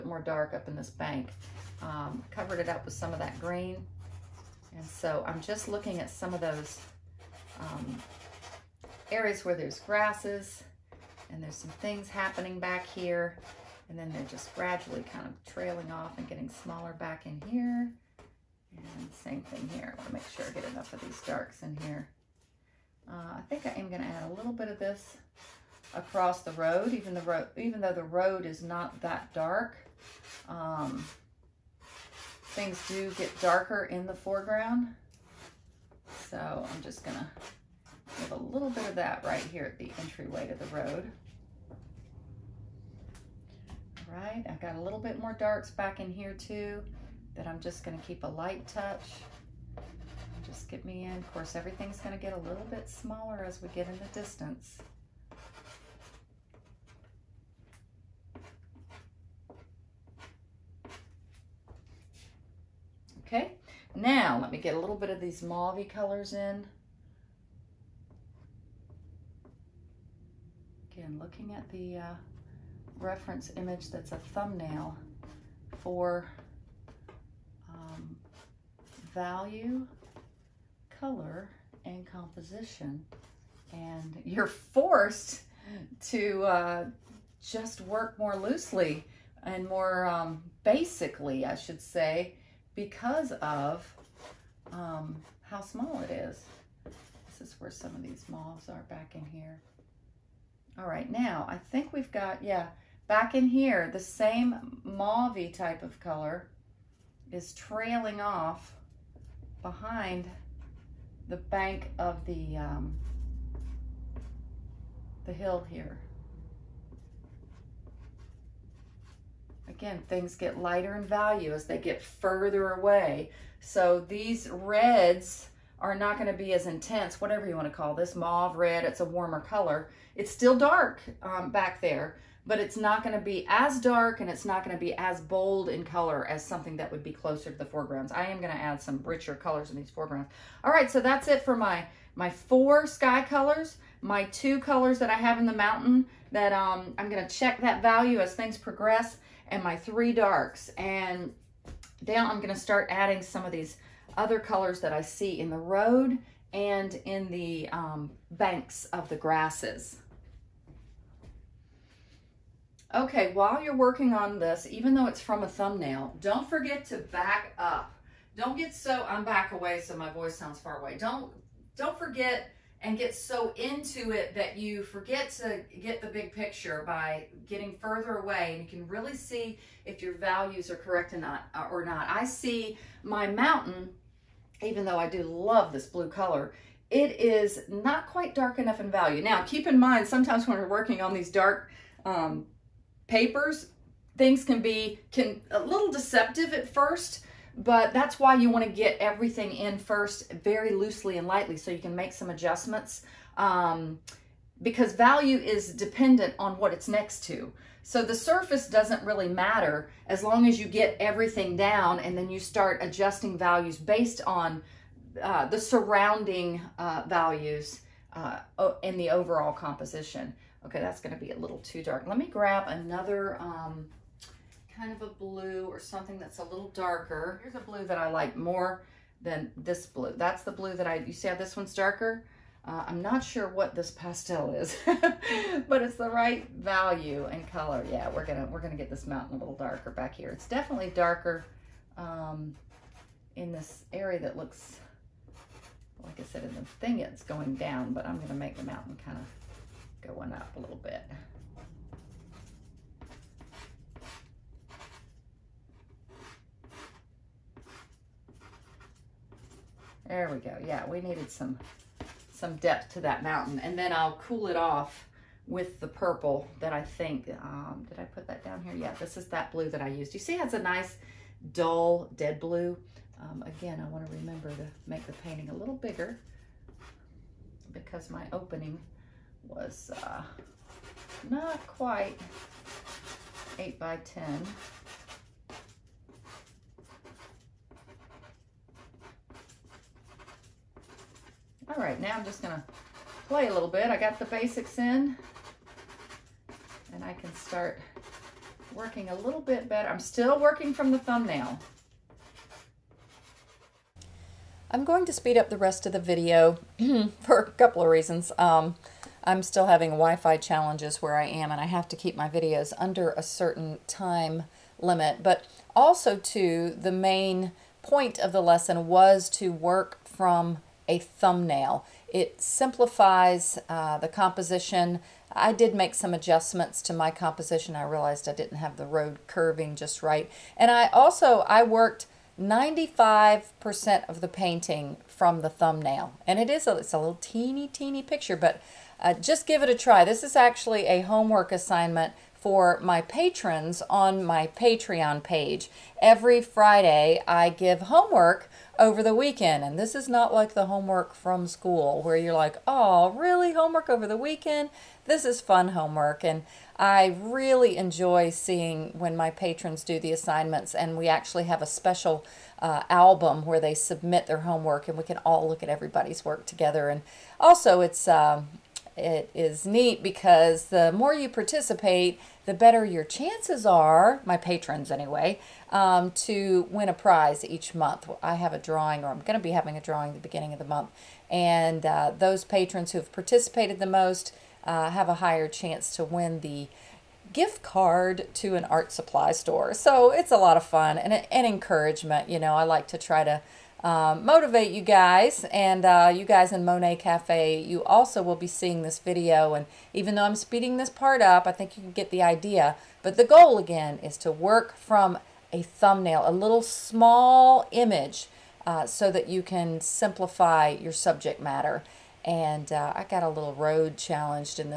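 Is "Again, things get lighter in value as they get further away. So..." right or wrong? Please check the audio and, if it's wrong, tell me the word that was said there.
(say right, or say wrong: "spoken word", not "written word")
right.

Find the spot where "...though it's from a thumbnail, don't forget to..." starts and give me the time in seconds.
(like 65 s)
164 s.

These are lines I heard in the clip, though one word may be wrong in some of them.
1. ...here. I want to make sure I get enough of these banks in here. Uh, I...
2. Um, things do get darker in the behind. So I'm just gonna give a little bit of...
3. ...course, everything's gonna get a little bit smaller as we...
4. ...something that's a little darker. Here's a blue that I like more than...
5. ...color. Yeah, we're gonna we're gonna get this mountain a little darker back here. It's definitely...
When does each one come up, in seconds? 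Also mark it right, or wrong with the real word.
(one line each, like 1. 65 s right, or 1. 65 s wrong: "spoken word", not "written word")
1. 19 s wrong: "darks", not "banks"
2. 30 s wrong: "foreground", not "behind"
3. 51 s right
4. 225 s right
5. 237 s right.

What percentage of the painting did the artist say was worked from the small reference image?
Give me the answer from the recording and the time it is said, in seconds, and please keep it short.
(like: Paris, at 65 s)
95%, at 332 s.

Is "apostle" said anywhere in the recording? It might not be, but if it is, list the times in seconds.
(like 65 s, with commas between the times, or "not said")
not said.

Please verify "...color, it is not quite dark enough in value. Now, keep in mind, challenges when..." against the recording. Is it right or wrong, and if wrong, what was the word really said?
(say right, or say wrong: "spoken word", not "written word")
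wrong: "sometimes", not "challenges".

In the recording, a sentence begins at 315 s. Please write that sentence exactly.
But also too, the main point of the lesson was to work from a thumbnail.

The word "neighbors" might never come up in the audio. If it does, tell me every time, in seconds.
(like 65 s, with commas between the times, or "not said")
not said.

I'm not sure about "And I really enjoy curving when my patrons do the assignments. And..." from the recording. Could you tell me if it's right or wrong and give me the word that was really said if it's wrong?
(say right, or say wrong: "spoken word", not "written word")
wrong: "seeing", not "curving".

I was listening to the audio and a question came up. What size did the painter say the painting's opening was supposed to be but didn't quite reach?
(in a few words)
8 by 10.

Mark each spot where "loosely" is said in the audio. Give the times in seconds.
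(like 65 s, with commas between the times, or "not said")
88 s, 200 s.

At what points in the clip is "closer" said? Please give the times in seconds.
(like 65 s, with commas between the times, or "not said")
137 s.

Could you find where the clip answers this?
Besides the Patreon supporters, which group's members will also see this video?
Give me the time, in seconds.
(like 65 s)
396 s.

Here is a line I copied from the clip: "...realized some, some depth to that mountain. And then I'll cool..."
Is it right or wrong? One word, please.
wrong.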